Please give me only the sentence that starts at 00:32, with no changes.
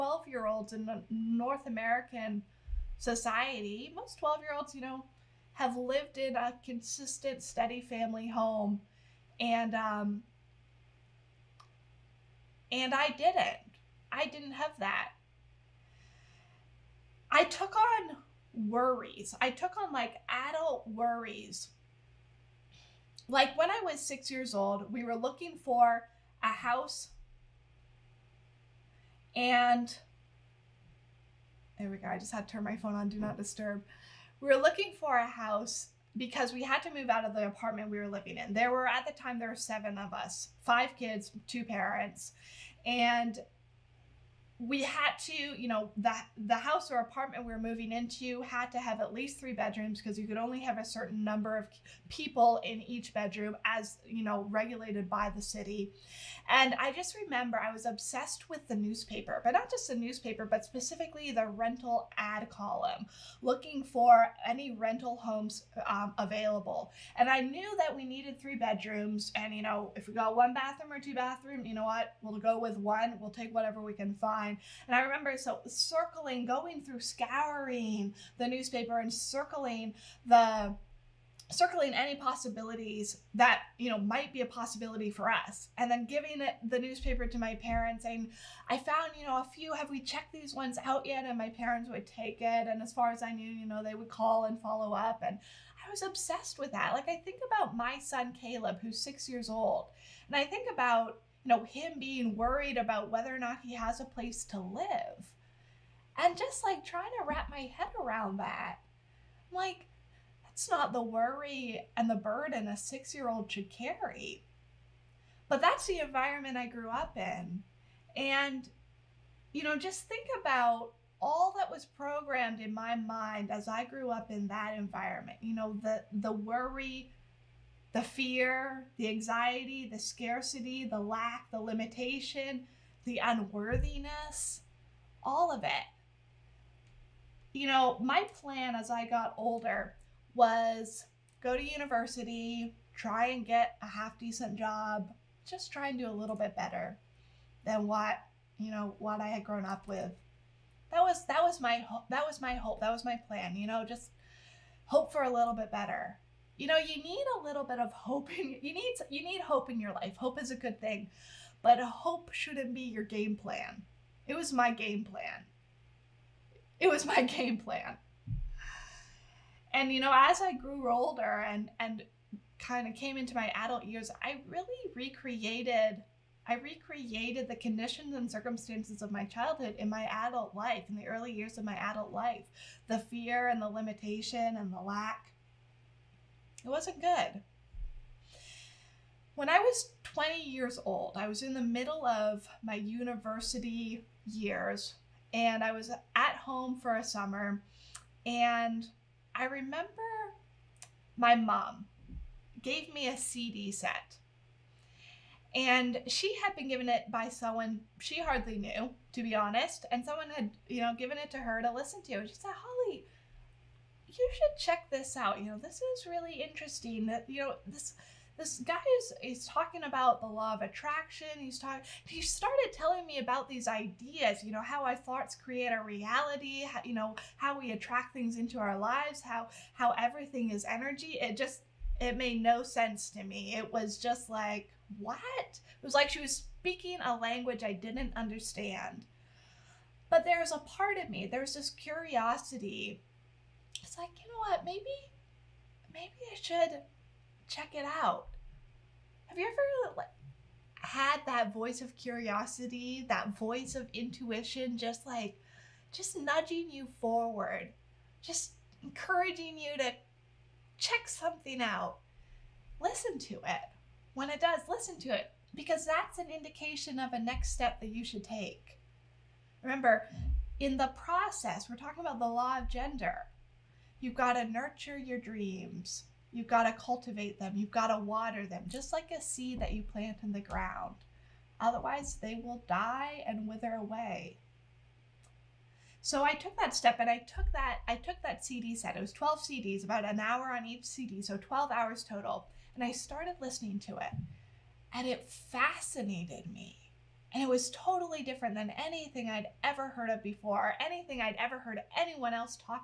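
I just had to turn my phone on, do not disturb.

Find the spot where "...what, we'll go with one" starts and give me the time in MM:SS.
01:11.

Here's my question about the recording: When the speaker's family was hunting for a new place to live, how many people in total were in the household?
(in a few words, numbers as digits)
7.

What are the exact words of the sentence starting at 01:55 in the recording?
But that's the environment I grew up in.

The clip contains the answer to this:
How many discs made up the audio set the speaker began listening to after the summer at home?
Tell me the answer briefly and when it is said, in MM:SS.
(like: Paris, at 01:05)
12, at 04:49.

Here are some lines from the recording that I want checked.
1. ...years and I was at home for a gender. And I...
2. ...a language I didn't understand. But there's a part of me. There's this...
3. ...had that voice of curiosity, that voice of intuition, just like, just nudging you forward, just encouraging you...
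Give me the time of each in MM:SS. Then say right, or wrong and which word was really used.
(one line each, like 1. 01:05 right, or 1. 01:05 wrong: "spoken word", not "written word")
1. 03:14 wrong: "summer", not "gender"
2. 03:57 right
3. 04:10 right.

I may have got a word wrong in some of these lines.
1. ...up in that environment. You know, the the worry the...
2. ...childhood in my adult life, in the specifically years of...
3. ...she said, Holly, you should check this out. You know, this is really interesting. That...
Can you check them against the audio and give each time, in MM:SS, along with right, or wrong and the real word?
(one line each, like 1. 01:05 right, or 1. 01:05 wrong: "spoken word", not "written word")
1. 02:04 right
2. 02:59 wrong: "early", not "specifically"
3. 03:32 right.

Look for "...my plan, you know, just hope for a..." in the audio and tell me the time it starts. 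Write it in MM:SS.
02:33.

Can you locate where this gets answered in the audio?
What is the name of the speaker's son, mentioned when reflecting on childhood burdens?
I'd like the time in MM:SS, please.
01:38.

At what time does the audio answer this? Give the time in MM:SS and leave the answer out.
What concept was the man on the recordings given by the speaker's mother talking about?
03:40.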